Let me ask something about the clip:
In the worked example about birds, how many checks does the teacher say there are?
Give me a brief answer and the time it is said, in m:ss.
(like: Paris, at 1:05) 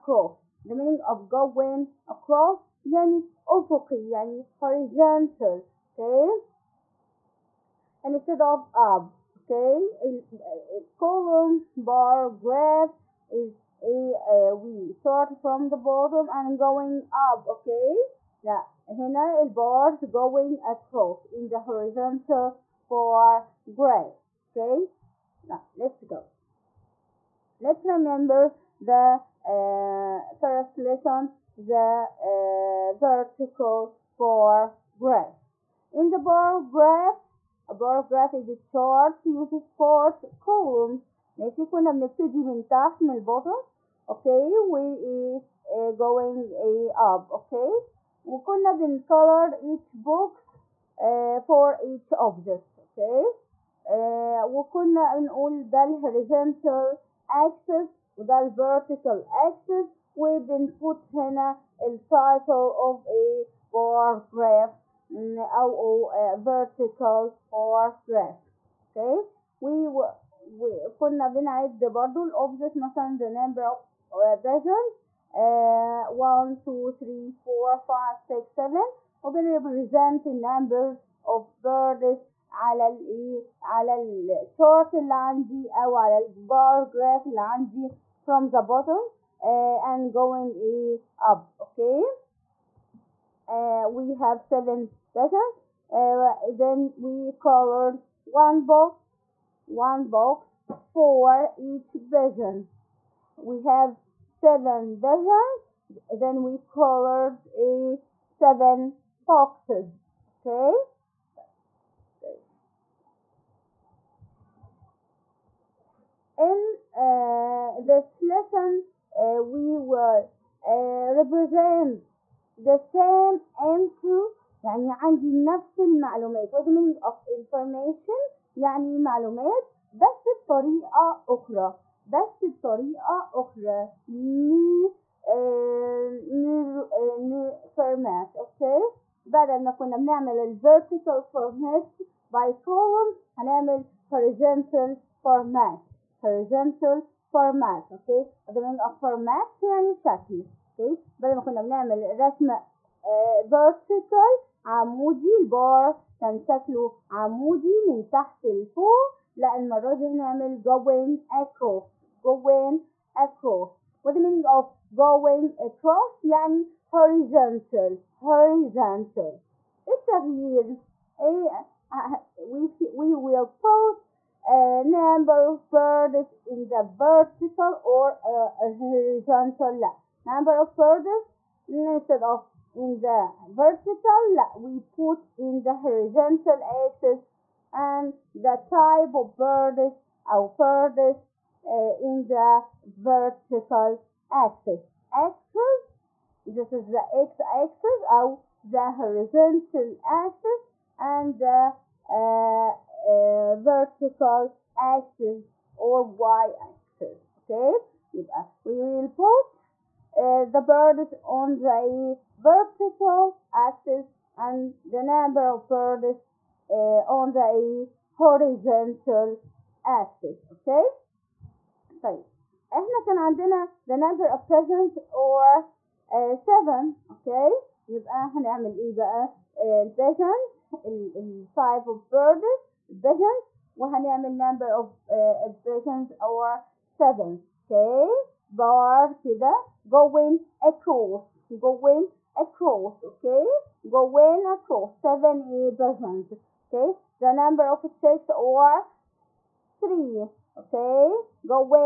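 3, at 4:07.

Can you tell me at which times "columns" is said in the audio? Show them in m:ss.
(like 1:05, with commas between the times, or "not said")
0:10, 0:40, 2:22.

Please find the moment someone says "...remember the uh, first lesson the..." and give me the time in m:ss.
0:27.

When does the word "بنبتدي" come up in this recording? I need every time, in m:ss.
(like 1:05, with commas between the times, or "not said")
0:41.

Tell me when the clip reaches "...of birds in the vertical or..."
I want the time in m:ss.
2:55.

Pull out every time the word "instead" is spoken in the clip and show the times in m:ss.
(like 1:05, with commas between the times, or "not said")
0:08, 3:01.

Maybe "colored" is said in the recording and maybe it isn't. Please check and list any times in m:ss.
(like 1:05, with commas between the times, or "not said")
0:49, 1:37, 1:46.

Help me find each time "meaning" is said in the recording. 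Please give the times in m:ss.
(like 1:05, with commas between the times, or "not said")
0:00, 2:06, 2:44.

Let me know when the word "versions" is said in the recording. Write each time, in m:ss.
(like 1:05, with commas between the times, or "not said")
1:14, 1:35, 1:42, 4:05.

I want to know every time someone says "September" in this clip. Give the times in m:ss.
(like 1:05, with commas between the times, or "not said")
not said.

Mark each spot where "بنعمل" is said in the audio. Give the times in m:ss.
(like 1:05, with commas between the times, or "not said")
2:19, 2:31.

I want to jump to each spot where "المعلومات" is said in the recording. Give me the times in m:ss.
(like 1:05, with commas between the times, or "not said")
2:05.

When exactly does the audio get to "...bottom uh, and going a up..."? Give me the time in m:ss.
1:28.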